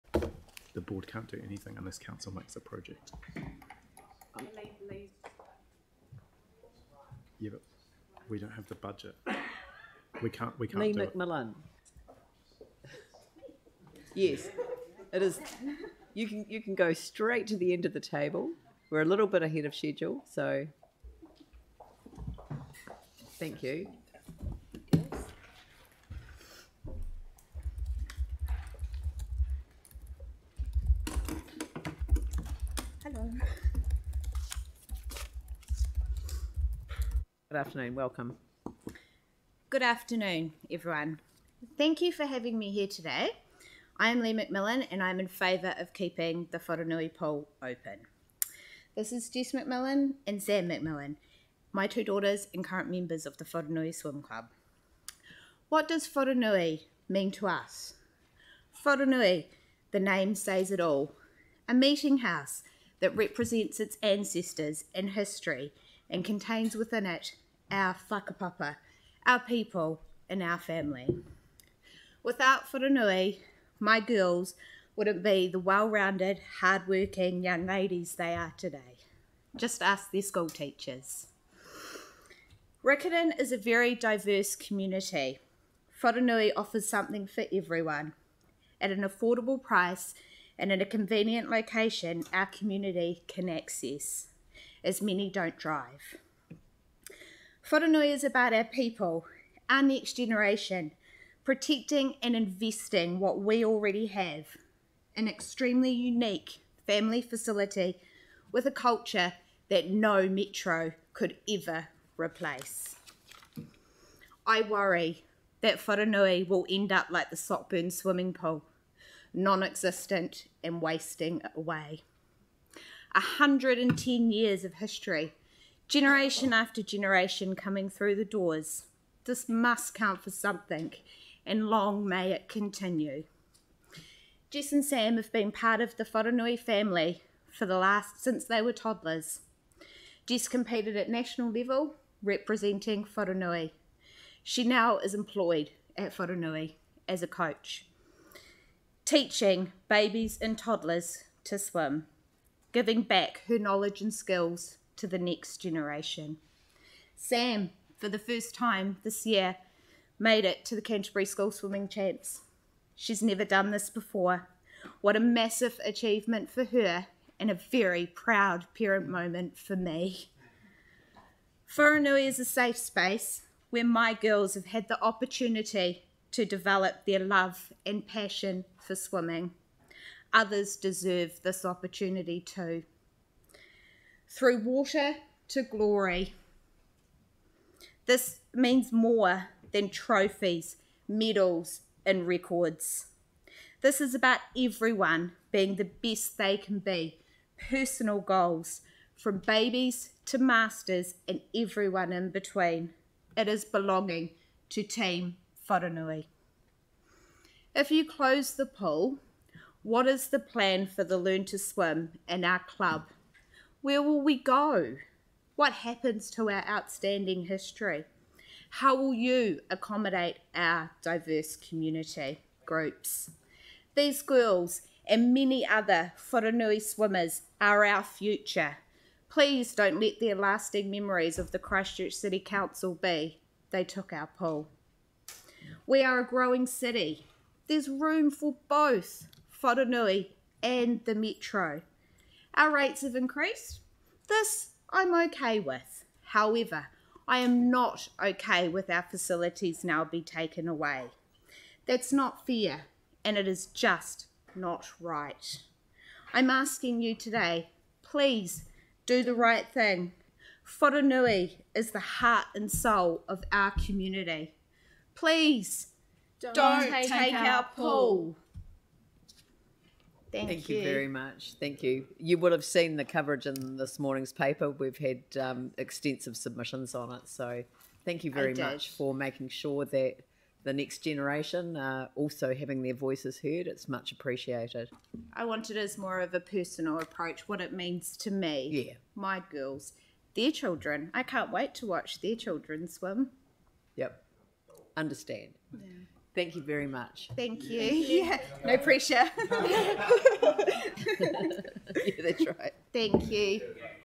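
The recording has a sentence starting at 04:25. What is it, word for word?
Please don't, don't take, take, our pool.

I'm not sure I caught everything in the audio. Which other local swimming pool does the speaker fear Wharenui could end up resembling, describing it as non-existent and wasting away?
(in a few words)
Sockburn swimming pool.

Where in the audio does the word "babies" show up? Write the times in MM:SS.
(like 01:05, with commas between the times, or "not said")
02:29, 03:19.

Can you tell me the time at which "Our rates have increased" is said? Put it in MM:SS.
04:02.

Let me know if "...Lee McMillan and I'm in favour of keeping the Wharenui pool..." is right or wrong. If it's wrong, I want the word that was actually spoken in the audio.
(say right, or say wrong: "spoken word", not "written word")
right.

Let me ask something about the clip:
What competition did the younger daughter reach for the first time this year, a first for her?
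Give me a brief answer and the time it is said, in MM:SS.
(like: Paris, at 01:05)
Canterbury School Swimming Champs, at 02:40.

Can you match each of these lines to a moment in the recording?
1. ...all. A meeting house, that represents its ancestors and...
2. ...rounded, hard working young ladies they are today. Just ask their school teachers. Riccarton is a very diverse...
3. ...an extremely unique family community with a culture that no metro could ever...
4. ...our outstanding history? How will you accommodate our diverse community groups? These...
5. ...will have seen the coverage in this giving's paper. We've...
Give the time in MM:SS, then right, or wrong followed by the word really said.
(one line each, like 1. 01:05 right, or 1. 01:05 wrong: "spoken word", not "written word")
1. 01:00 right
2. 01:15 right
3. 01:45 wrong: "facility", not "community"
4. 03:36 right
5. 04:32 wrong: "morning", not "giving".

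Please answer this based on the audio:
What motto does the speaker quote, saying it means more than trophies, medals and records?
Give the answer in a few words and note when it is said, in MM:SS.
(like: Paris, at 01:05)
Through water to glory, at 03:04.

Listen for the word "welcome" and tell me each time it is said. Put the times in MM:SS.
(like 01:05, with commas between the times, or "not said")
00:37.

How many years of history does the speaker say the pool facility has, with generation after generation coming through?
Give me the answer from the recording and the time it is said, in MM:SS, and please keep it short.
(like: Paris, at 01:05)
110, at 02:03.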